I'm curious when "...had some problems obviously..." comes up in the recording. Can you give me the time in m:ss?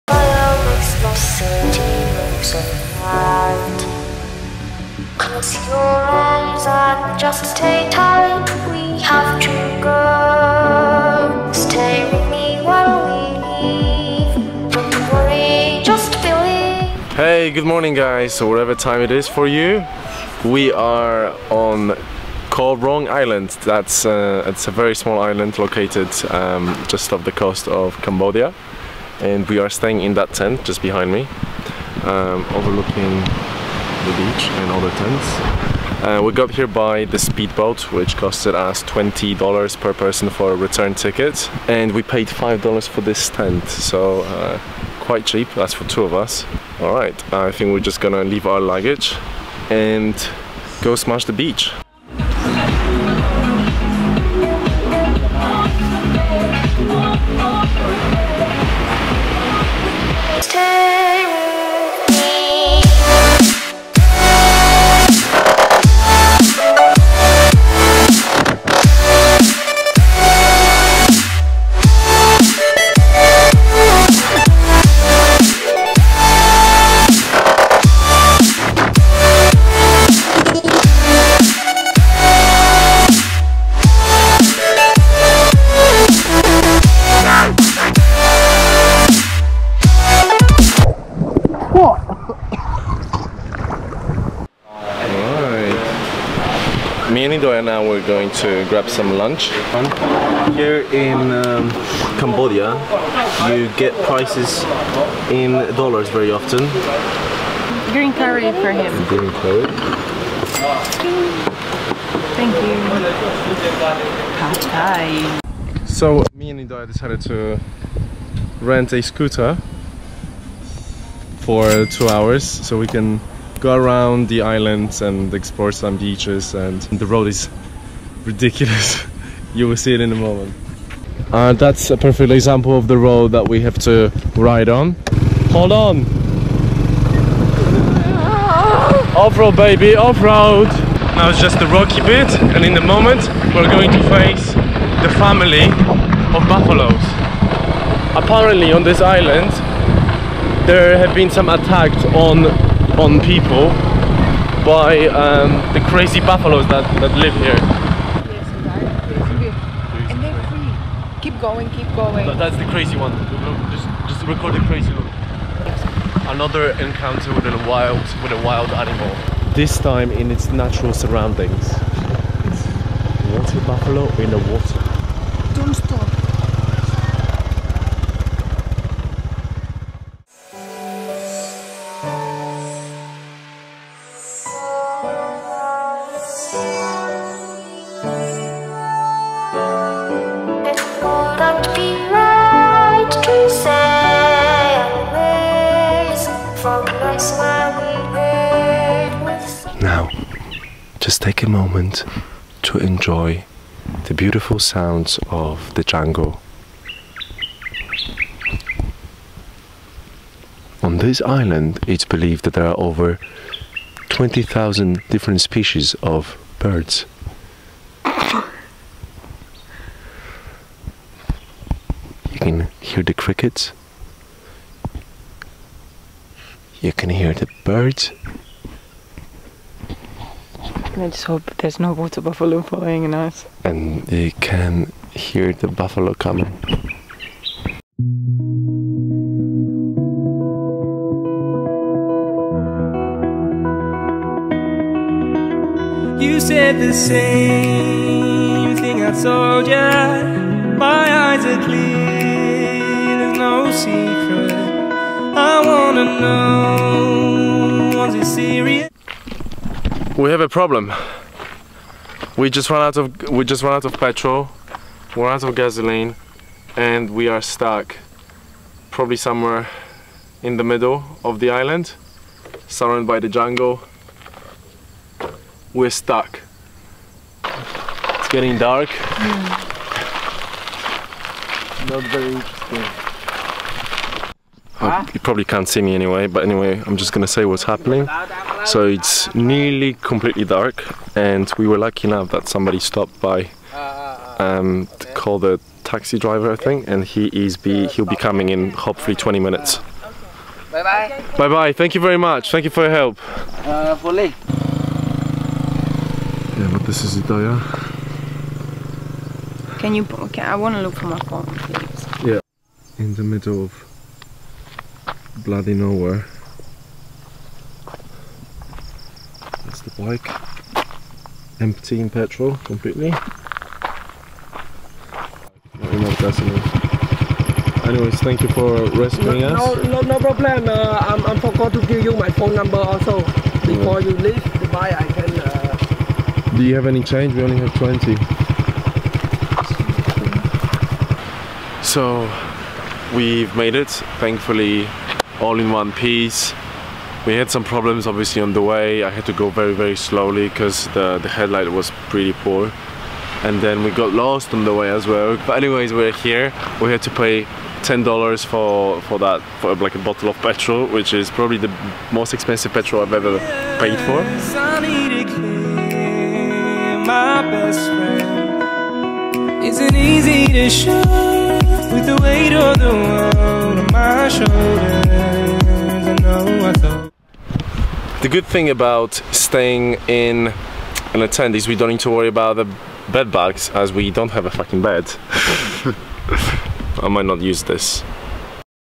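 5:47.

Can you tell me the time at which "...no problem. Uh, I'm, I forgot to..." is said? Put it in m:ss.
5:30.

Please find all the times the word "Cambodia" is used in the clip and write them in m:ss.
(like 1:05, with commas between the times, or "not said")
0:28, 1:42.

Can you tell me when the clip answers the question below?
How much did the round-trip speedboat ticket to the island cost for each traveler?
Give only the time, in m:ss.
0:38.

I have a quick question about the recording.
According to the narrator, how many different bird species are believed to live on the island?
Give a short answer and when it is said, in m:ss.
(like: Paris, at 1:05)
20,000, at 3:34.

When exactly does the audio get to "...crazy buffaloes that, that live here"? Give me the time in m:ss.
2:35.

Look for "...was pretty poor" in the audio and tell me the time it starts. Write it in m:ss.
5:51.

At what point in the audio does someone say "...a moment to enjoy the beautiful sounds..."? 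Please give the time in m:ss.
3:21.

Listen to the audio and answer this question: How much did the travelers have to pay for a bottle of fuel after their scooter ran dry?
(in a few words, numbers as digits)
$10.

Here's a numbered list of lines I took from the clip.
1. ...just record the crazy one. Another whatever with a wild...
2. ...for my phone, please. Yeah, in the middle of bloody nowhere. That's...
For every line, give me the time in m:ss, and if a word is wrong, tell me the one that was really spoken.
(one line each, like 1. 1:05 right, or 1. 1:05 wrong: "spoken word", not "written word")
1. 2:44 wrong: "encounter", not "whatever"
2. 5:10 right.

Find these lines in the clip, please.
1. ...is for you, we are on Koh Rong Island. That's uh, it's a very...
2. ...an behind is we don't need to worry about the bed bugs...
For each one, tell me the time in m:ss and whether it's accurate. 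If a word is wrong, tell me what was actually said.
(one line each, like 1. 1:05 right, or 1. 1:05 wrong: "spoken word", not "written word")
1. 0:19 right
2. 6:21 wrong: "attend", not "behind".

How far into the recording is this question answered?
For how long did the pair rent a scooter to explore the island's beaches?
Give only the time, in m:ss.
2:01.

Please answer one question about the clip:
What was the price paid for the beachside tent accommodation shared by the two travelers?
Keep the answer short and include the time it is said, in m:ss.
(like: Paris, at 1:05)
$5, at 0:42.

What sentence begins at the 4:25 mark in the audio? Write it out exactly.
We're out of gasoline, and we are stuck, probably somewhere in the middle of the island, surrounded by the jungle.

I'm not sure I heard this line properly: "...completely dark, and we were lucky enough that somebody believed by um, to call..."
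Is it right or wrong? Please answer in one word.
wrong.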